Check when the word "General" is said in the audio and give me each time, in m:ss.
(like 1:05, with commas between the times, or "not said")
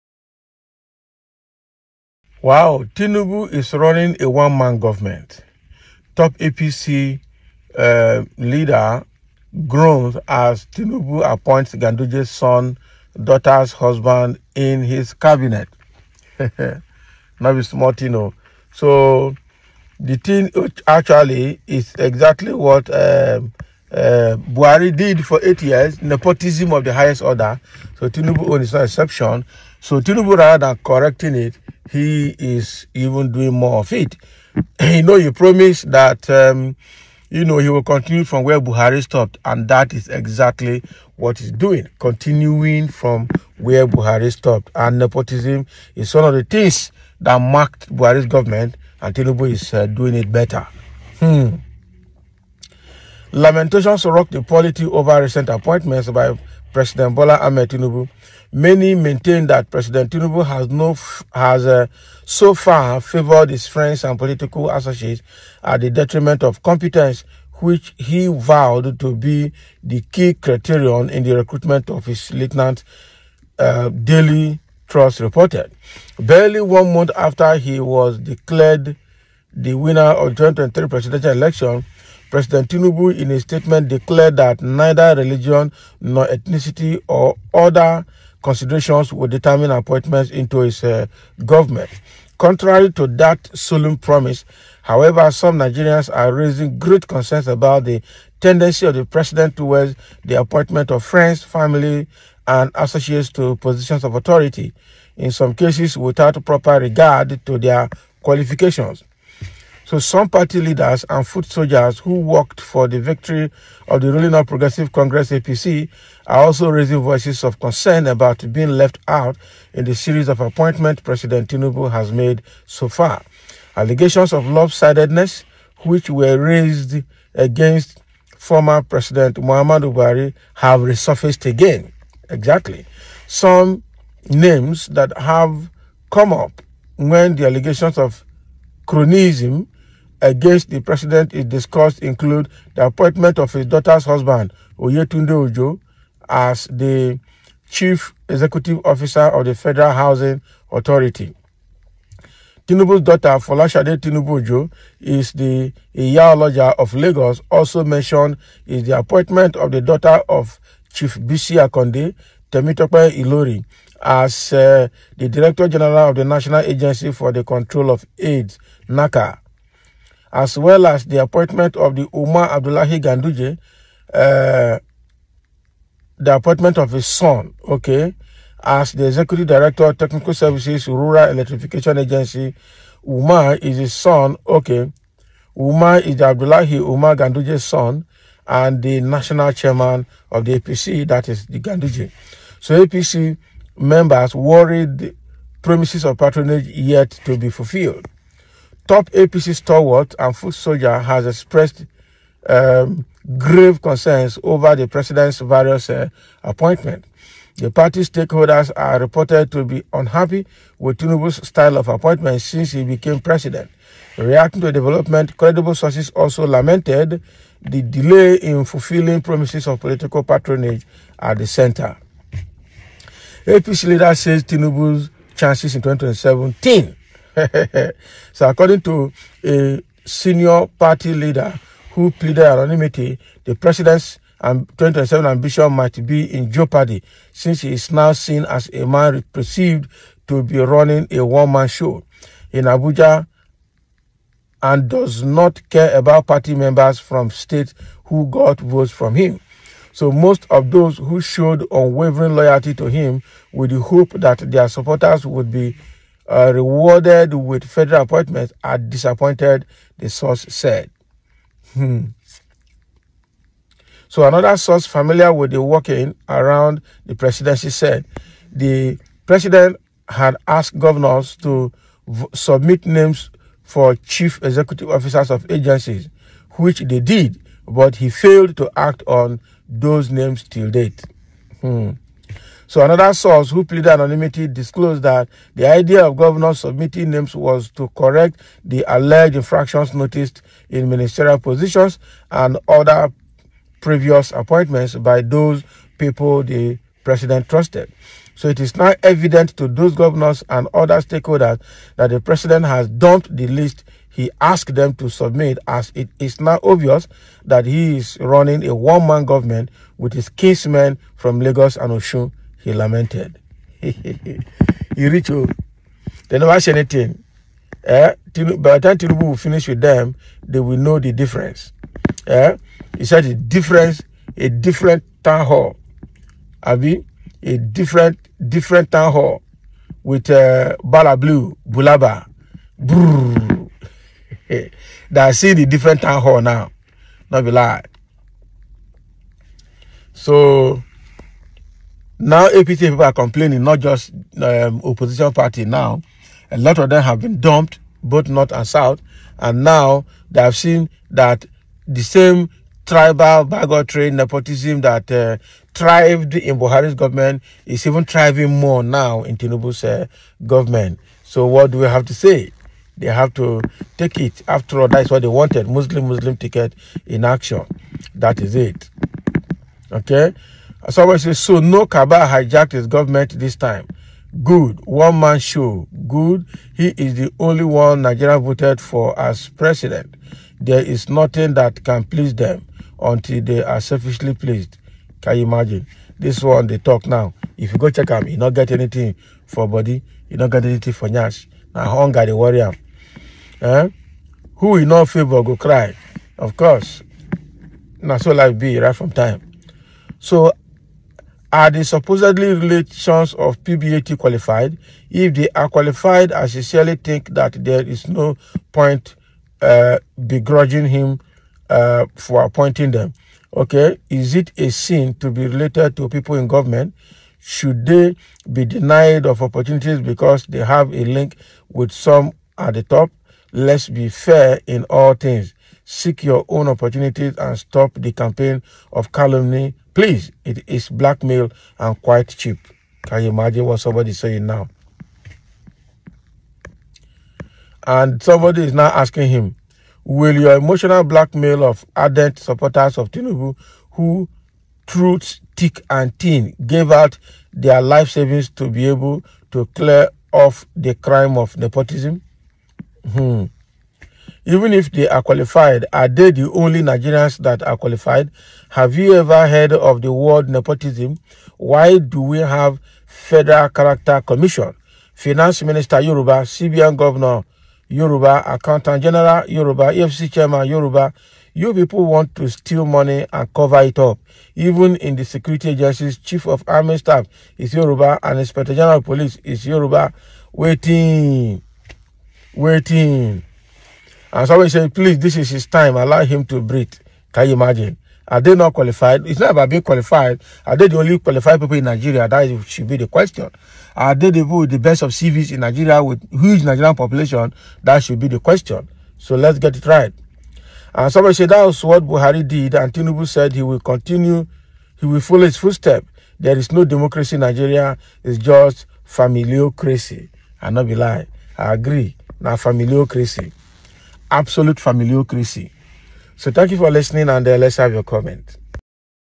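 2:45, 7:49, 7:58.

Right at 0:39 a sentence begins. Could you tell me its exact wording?
And that is exactly what he's doing, continuing from where Buhari stopped.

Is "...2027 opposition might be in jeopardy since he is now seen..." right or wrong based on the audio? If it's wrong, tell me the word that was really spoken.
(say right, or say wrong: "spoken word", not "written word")
wrong: "ambition", not "opposition".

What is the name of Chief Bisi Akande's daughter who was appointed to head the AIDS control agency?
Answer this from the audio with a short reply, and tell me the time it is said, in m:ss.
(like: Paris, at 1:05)
Temitope Ilori, at 2:42.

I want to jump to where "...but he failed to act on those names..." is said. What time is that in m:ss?
4:37.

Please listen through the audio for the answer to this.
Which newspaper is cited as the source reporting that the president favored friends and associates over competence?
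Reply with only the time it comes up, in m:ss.
1:13.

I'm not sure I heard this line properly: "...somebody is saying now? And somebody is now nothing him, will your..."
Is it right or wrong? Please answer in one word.
wrong.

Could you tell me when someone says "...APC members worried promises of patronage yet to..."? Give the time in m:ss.
3:12.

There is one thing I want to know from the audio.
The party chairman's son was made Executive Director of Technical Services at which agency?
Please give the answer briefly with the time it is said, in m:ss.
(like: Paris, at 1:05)
Rural Electrification Agency, at 3:00.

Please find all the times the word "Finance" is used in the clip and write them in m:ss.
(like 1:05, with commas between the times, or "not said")
7:45.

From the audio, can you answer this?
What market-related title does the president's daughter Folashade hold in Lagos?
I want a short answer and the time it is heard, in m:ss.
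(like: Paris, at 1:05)
Iyaoloja, at 2:35.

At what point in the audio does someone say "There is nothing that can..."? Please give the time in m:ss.
6:20.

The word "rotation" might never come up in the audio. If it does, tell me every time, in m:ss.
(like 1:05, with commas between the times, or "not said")
not said.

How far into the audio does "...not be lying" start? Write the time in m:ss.
8:30.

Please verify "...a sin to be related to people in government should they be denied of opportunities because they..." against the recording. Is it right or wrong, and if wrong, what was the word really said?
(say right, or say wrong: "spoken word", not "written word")
right.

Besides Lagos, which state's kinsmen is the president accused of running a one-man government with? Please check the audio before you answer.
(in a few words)
Osun.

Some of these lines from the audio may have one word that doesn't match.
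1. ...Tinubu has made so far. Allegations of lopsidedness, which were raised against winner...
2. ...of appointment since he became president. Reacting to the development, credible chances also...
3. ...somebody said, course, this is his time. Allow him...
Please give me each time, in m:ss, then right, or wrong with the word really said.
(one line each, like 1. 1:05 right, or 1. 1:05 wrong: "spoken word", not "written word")
1. 2:01 wrong: "former", not "winner"
2. 3:31 wrong: "sources", not "chances"
3. 8:04 wrong: "please", not "course".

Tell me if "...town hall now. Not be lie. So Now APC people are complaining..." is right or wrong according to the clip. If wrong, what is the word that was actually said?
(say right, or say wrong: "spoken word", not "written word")
right.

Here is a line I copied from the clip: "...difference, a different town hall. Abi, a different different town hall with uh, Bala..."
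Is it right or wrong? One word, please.
right.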